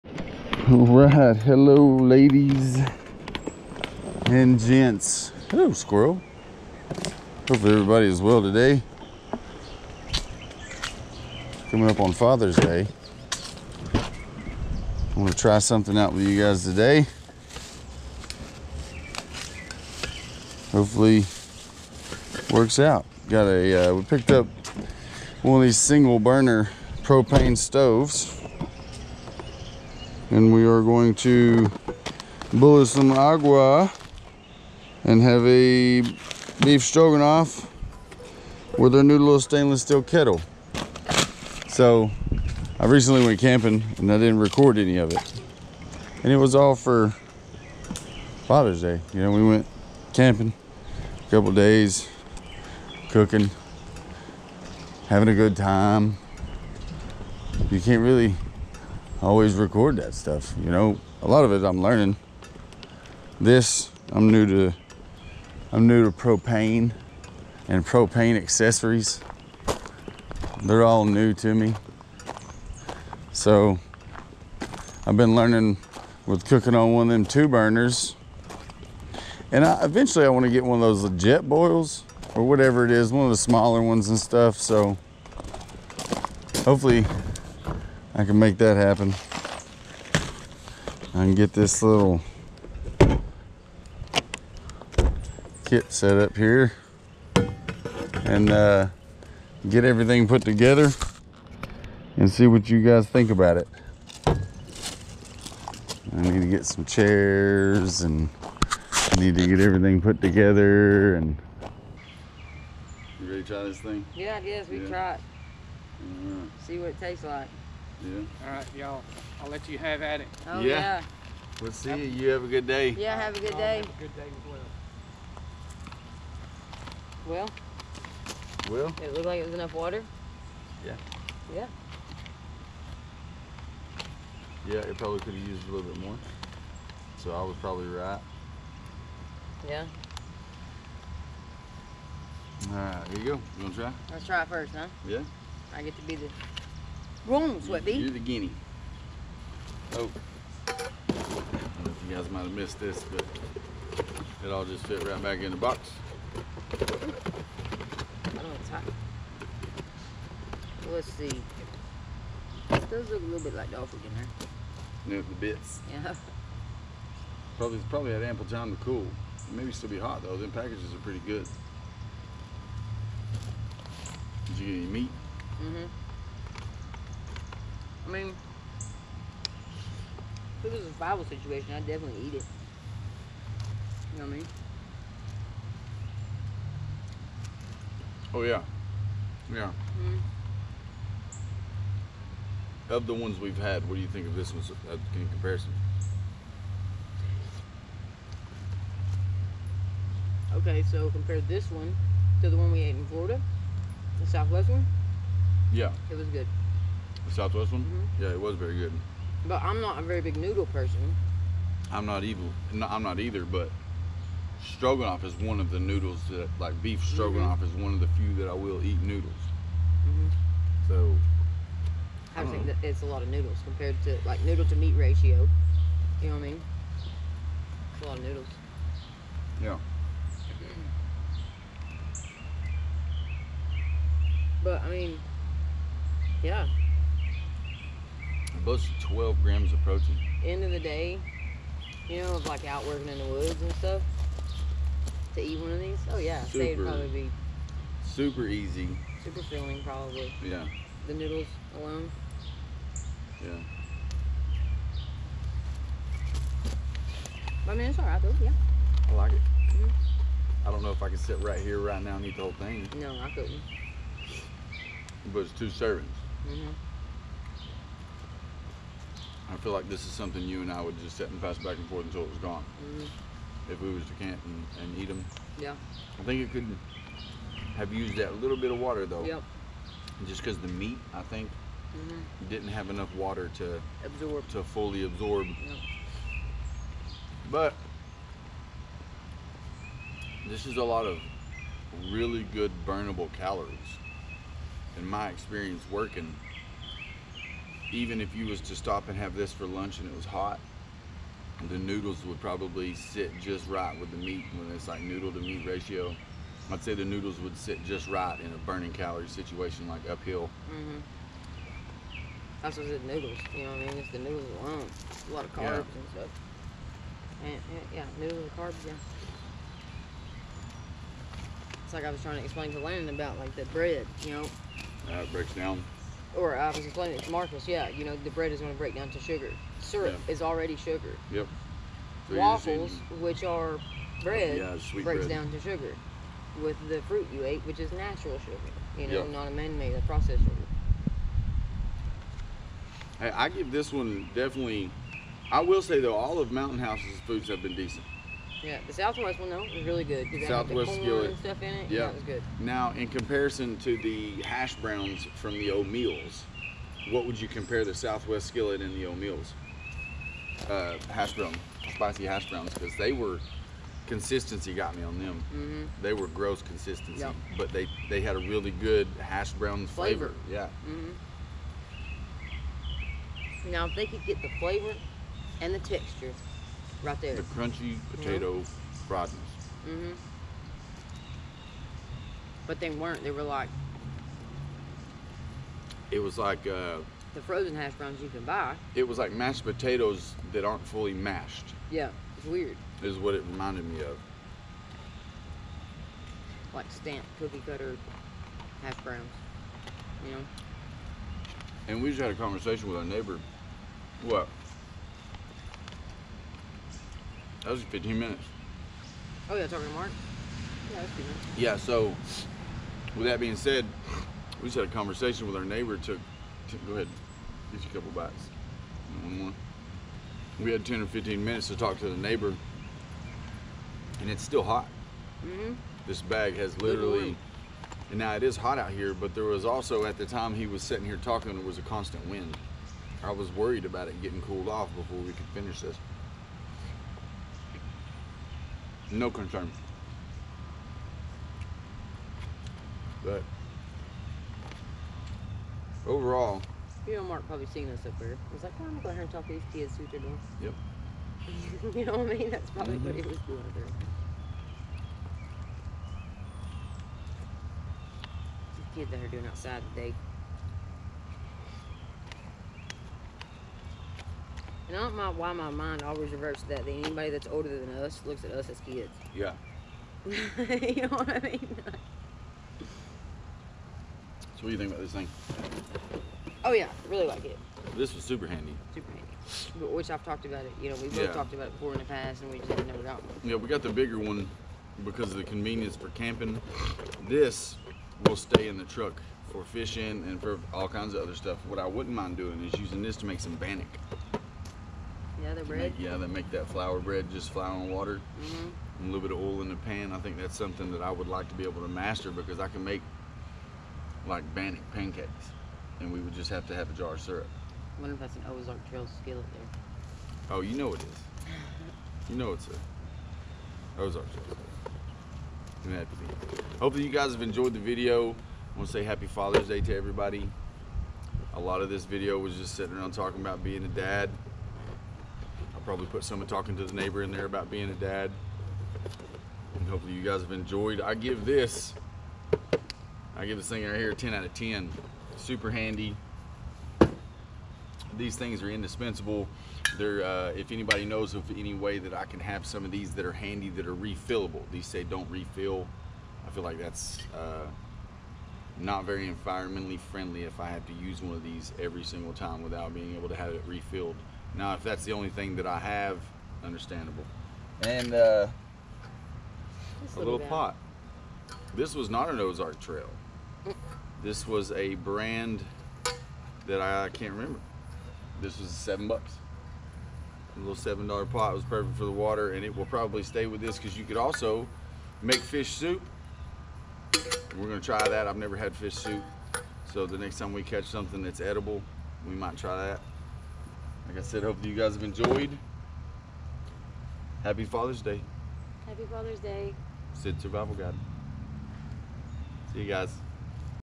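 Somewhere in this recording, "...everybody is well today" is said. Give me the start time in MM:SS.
00:07.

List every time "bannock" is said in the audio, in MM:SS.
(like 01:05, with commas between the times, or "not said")
08:13, 08:24.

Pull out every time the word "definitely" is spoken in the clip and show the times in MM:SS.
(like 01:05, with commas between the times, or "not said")
03:01, 05:44.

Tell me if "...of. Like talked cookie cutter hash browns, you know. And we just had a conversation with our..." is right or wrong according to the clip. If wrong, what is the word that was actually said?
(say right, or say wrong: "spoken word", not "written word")
wrong: "stamped", not "talked".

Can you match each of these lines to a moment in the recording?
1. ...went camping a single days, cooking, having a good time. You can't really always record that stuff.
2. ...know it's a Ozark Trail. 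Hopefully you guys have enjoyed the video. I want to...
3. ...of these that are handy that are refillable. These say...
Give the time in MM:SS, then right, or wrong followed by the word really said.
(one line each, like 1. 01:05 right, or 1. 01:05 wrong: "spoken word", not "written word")
1. 00:49 wrong: "couple", not "single"
2. 08:32 right
3. 09:02 right.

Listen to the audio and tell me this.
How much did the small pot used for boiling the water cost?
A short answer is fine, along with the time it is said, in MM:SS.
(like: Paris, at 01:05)
7 dollars, at 09:28.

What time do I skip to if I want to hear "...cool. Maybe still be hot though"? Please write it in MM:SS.
02:48.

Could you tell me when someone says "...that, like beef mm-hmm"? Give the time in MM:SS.
03:36.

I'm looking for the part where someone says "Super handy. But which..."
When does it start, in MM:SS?
07:58.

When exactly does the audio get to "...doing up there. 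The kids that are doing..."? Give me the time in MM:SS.
07:33.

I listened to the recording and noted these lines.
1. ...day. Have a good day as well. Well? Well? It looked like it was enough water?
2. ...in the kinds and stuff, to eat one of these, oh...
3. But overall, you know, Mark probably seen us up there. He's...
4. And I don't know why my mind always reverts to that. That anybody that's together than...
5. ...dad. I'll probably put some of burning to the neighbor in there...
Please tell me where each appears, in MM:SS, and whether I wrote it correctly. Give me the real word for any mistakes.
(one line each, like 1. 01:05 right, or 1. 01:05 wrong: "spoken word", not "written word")
1. 02:03 right
2. 04:03 wrong: "woods", not "kinds"
3. 07:23 right
4. 07:44 wrong: "older", not "together"
5. 08:44 wrong: "talking", not "burning".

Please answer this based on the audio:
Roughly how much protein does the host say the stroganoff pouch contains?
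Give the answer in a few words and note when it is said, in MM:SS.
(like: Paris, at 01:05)
12 grams, at 03:59.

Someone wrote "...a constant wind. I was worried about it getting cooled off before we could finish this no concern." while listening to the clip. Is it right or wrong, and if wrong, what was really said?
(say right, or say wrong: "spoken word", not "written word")
right.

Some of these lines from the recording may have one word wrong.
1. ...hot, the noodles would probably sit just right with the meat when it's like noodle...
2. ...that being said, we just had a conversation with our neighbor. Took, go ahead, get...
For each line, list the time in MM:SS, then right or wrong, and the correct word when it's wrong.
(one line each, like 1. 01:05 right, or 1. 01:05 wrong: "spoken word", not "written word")
1. 05:00 right
2. 06:53 right.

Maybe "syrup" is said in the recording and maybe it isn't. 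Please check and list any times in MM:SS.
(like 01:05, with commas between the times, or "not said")
05:29, 08:27.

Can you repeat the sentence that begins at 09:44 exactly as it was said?
Like I said, hopefully you guys have enjoyed.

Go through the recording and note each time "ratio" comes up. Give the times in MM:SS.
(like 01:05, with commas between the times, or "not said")
03:44, 05:05.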